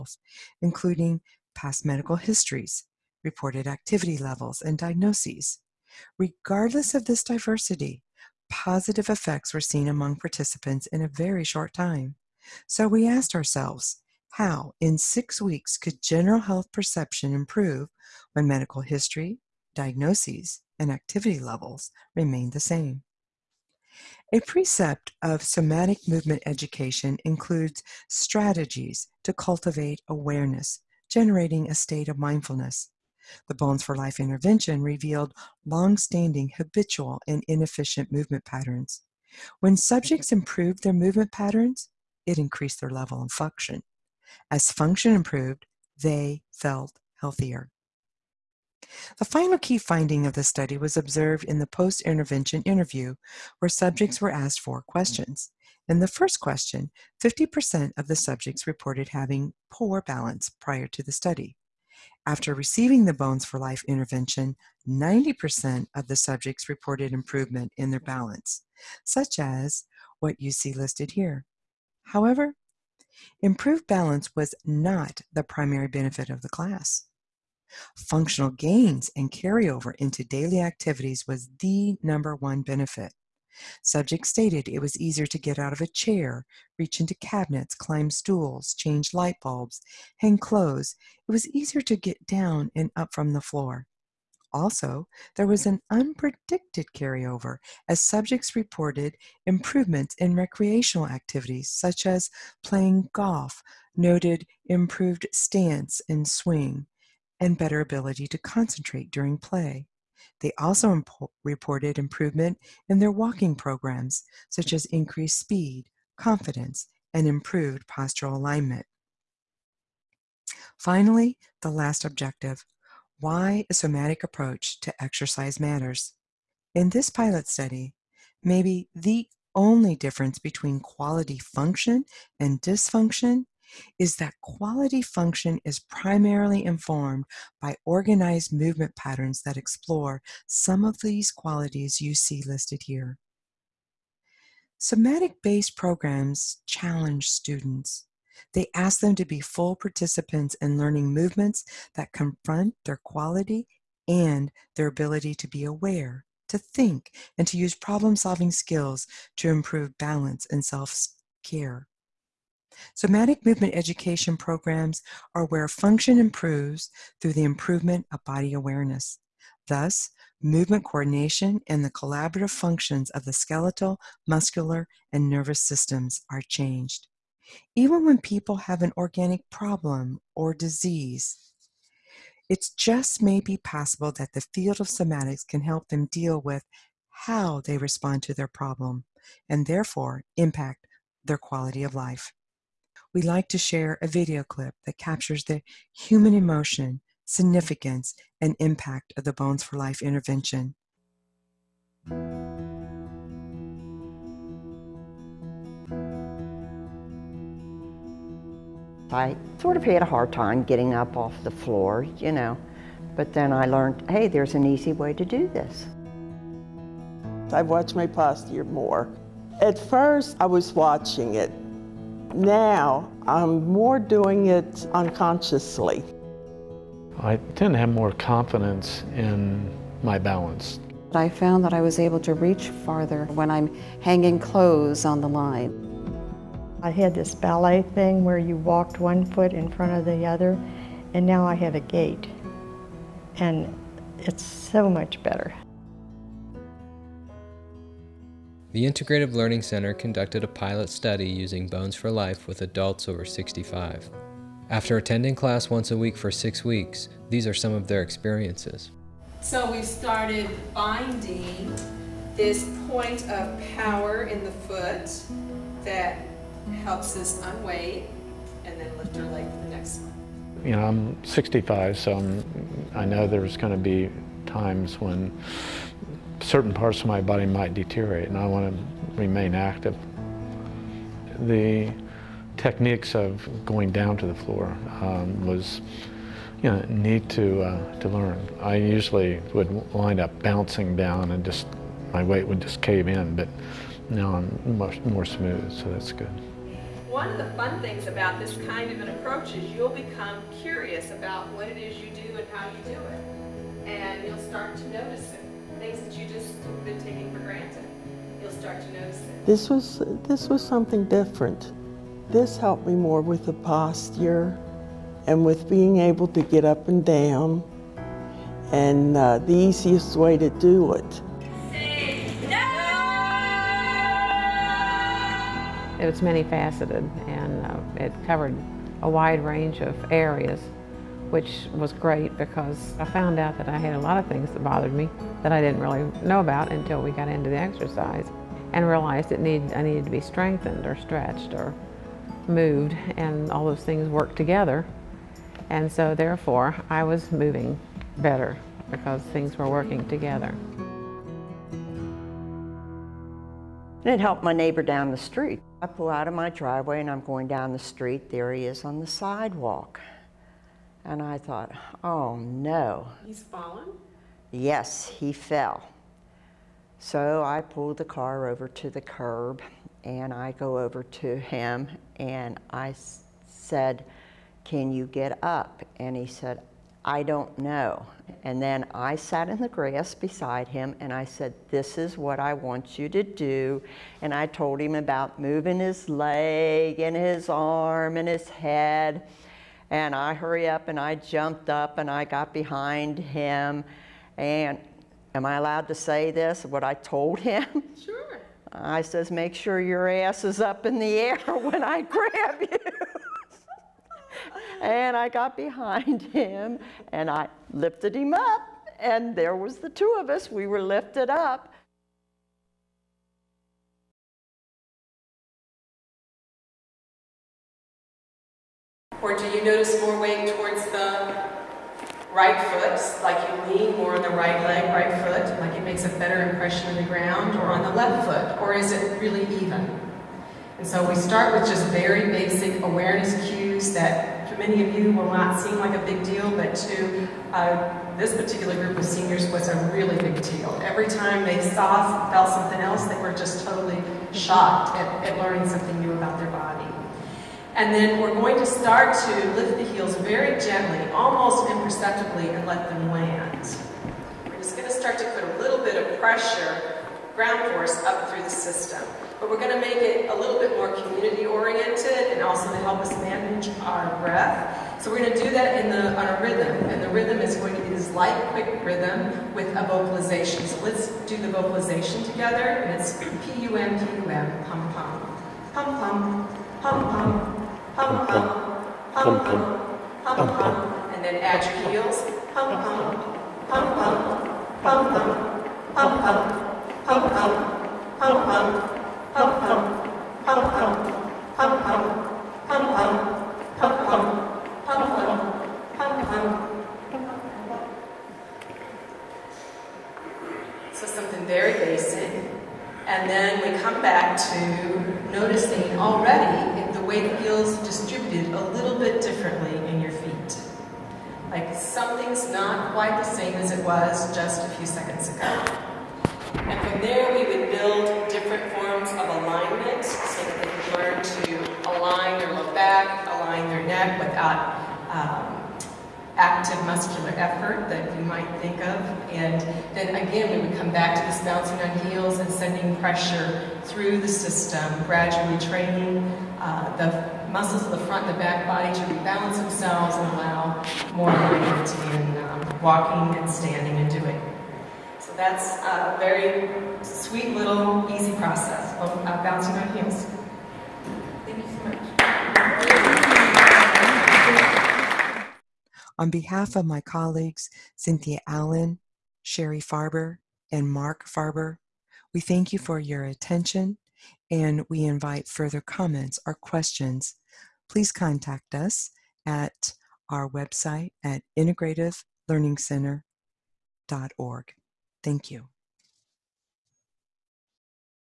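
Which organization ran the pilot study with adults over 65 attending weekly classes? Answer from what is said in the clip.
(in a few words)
The Integrative Learning Center.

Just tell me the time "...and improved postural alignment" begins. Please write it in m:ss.
1:57.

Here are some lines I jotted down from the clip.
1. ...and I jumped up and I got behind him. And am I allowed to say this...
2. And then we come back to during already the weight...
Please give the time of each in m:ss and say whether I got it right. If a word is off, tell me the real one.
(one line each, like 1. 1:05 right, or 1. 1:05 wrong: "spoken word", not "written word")
1. 6:30 right
2. 8:23 wrong: "noticing", not "during".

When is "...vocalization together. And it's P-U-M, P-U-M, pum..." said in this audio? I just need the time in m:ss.
7:51.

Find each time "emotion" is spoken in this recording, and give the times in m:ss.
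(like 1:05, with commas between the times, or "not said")
3:16.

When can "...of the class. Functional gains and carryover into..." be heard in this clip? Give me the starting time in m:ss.
1:16.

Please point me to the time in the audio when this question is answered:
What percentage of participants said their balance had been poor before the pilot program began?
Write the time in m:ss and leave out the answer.
0:57.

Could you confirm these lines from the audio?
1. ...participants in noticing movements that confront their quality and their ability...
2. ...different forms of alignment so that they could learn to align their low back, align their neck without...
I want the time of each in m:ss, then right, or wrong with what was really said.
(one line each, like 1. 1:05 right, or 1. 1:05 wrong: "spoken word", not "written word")
1. 2:29 wrong: "learning", not "noticing"
2. 8:38 right.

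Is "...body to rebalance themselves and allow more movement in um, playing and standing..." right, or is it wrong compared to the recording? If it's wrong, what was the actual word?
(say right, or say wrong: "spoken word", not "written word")
wrong: "walking", not "playing".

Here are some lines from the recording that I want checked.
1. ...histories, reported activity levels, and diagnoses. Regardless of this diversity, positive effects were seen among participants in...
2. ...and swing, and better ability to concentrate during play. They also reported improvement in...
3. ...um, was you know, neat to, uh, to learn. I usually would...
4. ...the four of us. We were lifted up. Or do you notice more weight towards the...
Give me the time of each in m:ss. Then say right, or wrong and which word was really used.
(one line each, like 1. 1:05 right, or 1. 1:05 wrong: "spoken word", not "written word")
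1. 0:02 right
2. 1:46 right
3. 4:45 right
4. 6:49 wrong: "two", not "four".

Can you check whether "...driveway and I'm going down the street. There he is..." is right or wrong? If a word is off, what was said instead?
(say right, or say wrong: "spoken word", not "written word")
right.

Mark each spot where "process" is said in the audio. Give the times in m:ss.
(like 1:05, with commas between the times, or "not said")
9:08.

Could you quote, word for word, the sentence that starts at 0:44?
As function improved, they felt healthier.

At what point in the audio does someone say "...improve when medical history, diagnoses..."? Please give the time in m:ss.
0:17.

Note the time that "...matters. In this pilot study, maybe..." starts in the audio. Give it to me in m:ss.
2:05.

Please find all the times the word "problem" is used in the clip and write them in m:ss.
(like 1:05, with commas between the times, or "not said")
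2:37, 2:59, 3:08.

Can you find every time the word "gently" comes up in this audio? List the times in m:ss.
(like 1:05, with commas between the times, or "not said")
7:30.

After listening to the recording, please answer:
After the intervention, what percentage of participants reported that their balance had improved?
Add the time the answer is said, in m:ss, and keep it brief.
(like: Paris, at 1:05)
90%, at 1:04.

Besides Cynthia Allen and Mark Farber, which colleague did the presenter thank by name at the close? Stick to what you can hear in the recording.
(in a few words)
Sherry Farber.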